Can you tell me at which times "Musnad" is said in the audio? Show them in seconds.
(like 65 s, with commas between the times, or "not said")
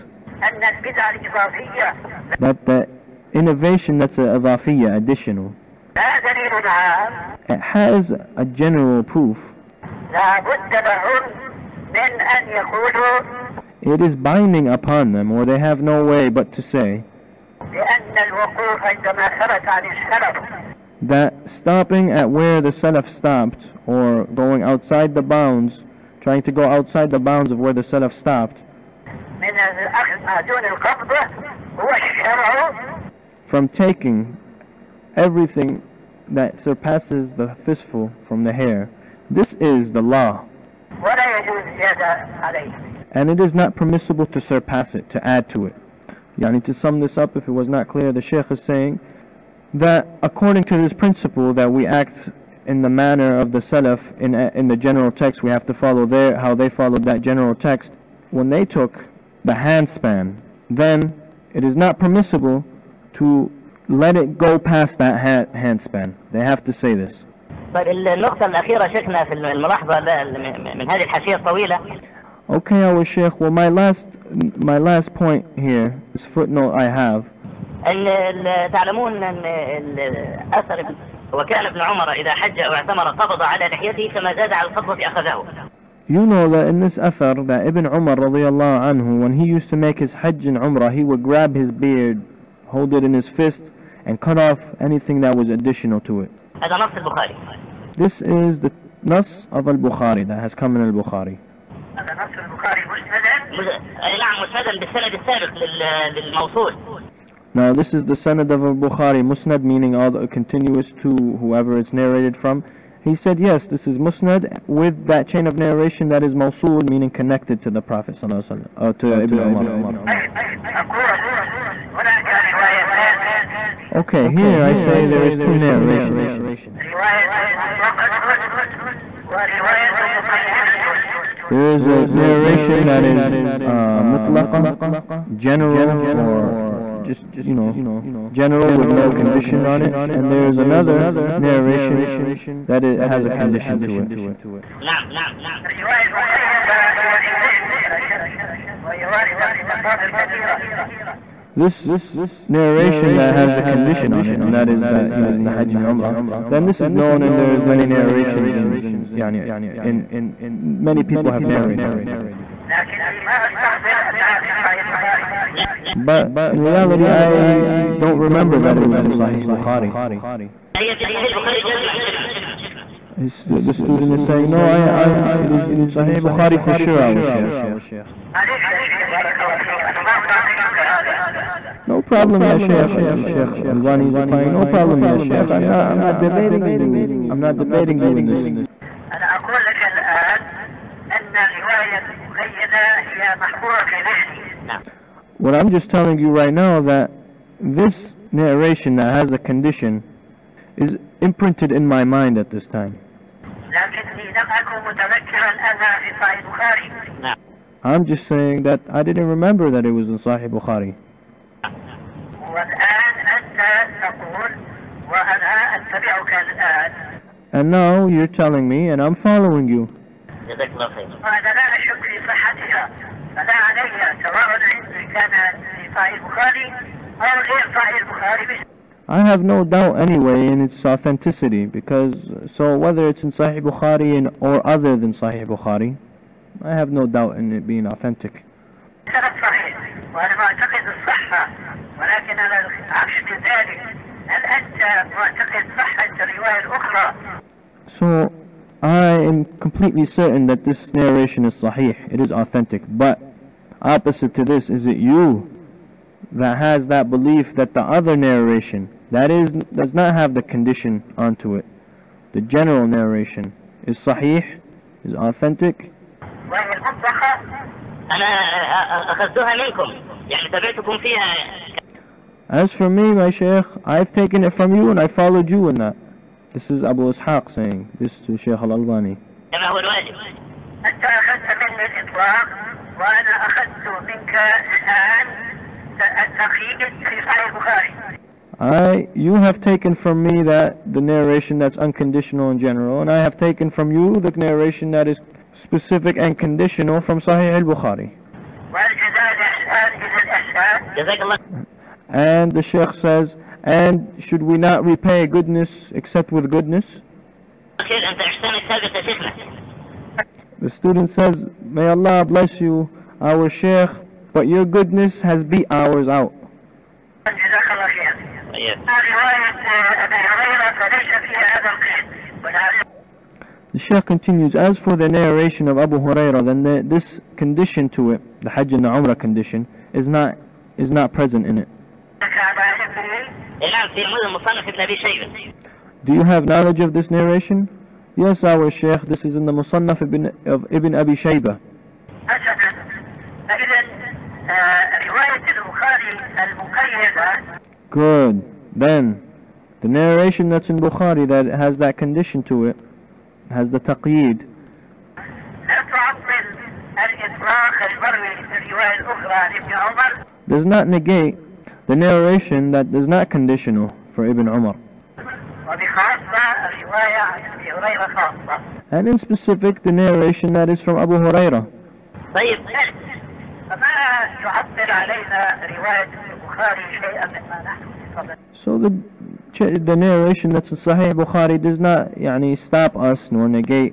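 109 s, 113 s.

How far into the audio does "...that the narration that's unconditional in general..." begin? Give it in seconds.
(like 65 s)
290 s.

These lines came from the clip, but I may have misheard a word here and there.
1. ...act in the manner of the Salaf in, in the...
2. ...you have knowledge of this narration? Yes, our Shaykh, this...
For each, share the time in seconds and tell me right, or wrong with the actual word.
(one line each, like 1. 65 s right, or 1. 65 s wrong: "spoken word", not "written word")
1. 51 s right
2. 336 s right.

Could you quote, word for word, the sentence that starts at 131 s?
There is a narration that is uh, mutlaqa, general, or just, you know, general with no condition on it.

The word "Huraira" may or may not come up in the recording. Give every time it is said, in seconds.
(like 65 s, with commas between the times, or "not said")
325 s, 371 s.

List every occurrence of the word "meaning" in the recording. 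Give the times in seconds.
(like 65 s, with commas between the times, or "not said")
109 s, 116 s.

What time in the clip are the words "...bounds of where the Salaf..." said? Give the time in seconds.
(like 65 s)
27 s.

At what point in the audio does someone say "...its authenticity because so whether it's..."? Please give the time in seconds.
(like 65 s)
230 s.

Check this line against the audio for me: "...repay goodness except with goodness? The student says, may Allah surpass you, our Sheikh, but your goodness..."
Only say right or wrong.
wrong.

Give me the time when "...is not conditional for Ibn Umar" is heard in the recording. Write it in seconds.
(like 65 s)
362 s.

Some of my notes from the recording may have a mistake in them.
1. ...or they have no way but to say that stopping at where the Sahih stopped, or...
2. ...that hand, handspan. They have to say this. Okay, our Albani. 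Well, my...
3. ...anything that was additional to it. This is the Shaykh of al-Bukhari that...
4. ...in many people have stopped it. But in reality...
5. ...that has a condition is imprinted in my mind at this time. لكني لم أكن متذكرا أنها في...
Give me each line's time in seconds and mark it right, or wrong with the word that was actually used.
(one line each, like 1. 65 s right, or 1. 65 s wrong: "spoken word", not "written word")
1. 15 s wrong: "Salaf", not "Sahih"
2. 64 s wrong: "Sheikh", not "Albani"
3. 94 s wrong: "Nas", not "Shaykh"
4. 159 s wrong: "narrated", not "stopped"
5. 198 s right.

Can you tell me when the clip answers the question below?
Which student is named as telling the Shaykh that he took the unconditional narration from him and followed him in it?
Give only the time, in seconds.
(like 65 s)
276 s.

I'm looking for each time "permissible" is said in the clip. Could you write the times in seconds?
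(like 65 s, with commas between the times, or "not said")
43 s, 61 s.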